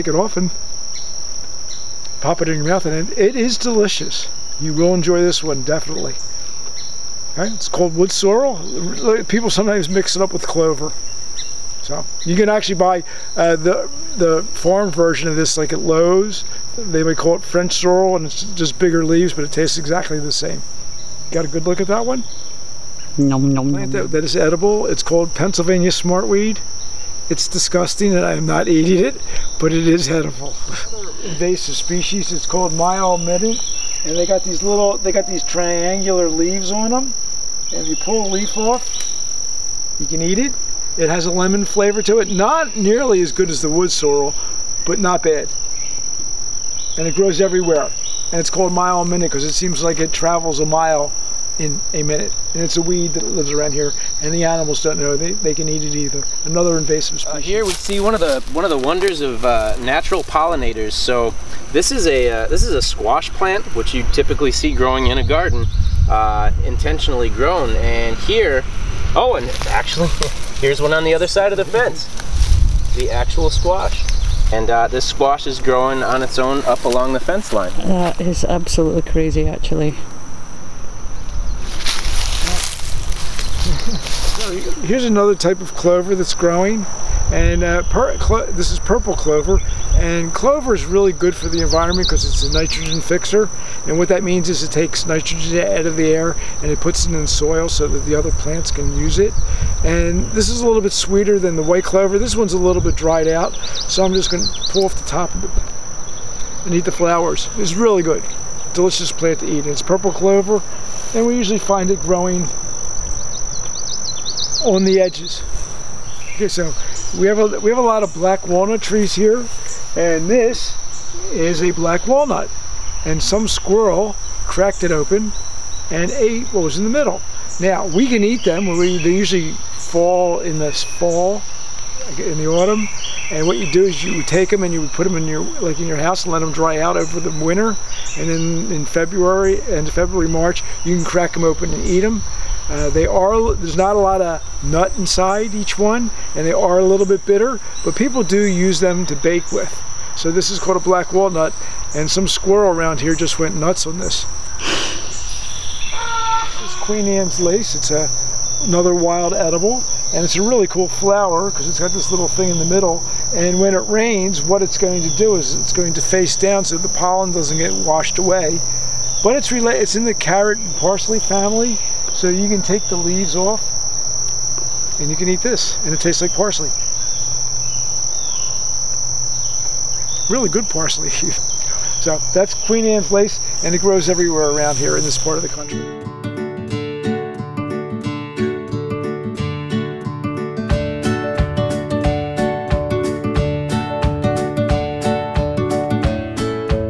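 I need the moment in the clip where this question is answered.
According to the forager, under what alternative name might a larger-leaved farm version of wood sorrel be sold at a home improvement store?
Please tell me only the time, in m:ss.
0:17.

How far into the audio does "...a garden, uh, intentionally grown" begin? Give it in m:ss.
1:05.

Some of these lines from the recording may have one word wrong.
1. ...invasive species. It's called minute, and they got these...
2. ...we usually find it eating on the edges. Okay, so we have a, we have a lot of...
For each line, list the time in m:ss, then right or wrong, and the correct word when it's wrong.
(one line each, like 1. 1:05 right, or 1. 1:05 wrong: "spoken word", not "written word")
1. 0:31 right
2. 1:51 wrong: "growing", not "eating".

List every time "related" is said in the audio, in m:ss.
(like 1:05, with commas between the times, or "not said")
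2:49.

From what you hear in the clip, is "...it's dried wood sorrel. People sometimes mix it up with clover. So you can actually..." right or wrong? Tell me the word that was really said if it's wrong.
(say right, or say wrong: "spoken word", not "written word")
wrong: "called", not "dried".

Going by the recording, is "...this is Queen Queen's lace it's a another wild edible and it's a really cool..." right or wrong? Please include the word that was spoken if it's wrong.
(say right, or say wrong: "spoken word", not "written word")
wrong: "Anne", not "Queen".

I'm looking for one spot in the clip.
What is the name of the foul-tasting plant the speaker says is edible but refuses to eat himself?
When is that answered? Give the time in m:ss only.
0:25.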